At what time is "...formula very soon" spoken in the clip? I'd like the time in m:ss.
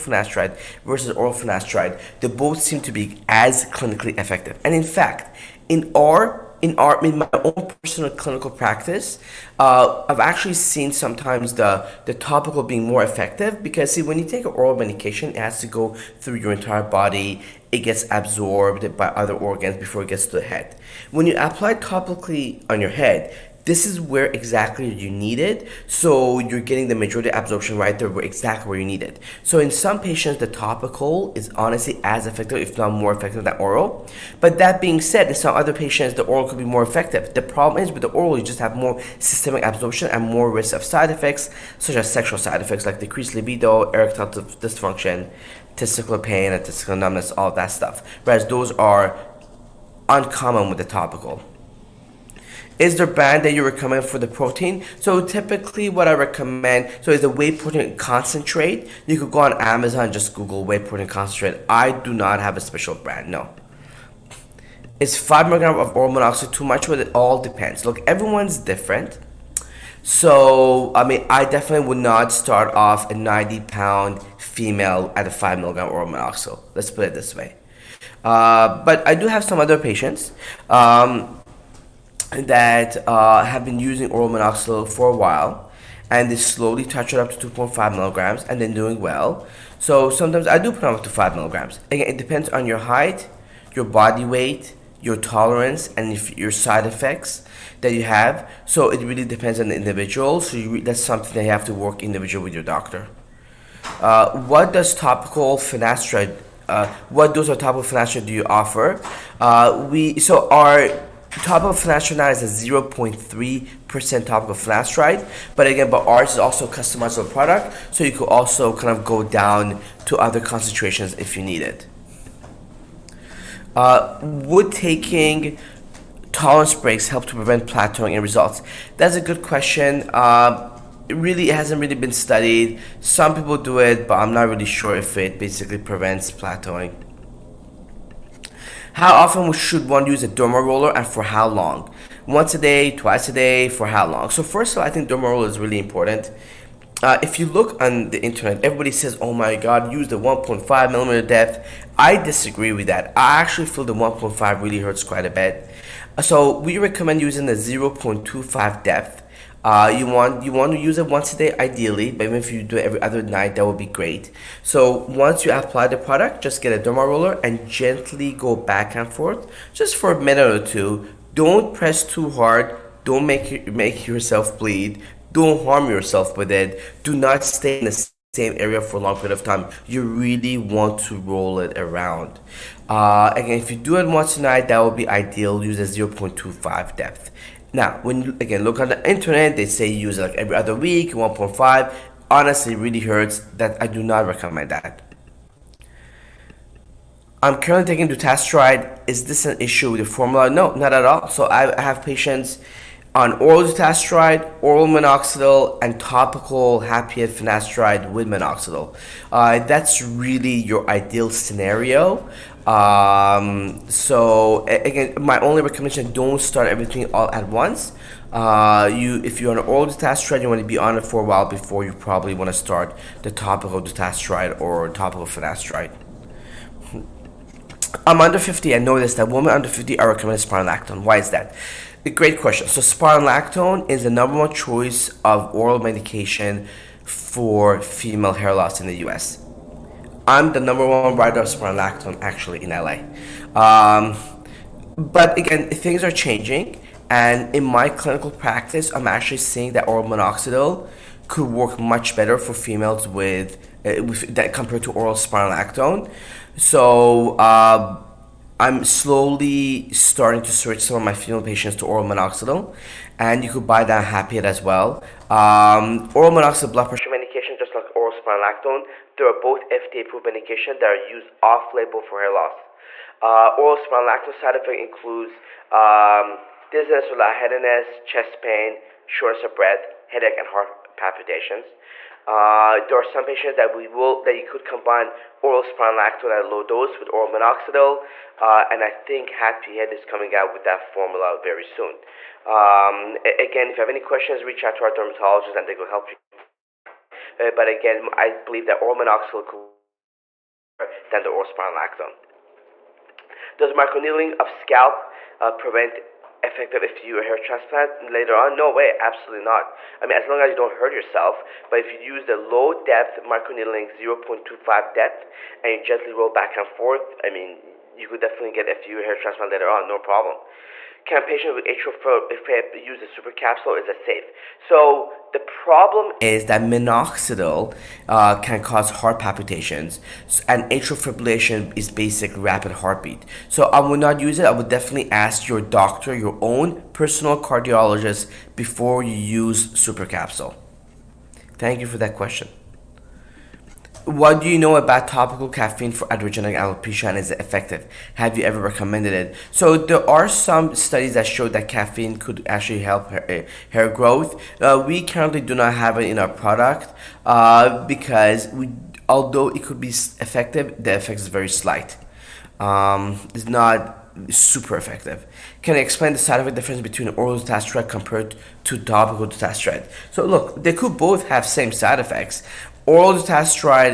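4:50.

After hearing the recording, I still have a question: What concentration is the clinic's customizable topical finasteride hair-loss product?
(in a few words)
0.3%.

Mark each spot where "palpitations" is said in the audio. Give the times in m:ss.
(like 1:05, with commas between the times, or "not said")
4:40, 5:29.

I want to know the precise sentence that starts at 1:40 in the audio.
So you, that's something that you have to work individual with your doctor.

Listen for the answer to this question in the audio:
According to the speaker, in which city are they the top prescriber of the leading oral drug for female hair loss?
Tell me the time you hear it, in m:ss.
4:02.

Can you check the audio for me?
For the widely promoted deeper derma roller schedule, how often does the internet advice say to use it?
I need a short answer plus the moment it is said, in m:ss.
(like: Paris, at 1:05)
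every other week, at 3:10.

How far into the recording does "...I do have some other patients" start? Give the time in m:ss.
1:19.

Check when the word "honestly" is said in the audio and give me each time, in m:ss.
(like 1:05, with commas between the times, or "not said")
0:31, 3:12.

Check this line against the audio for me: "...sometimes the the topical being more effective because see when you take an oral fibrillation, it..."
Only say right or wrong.
wrong.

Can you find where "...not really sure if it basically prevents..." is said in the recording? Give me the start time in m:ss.
2:14.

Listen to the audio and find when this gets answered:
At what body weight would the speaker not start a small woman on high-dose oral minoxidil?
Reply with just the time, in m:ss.
1:13.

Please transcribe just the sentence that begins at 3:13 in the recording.
That I do not recommend that.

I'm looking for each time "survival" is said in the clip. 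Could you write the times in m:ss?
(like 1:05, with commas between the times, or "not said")
not said.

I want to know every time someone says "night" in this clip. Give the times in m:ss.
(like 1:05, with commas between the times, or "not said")
2:43, 3:04.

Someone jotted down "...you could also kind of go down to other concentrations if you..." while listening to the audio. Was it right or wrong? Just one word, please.
right.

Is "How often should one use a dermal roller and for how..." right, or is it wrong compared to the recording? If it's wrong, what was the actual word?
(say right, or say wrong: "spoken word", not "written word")
right.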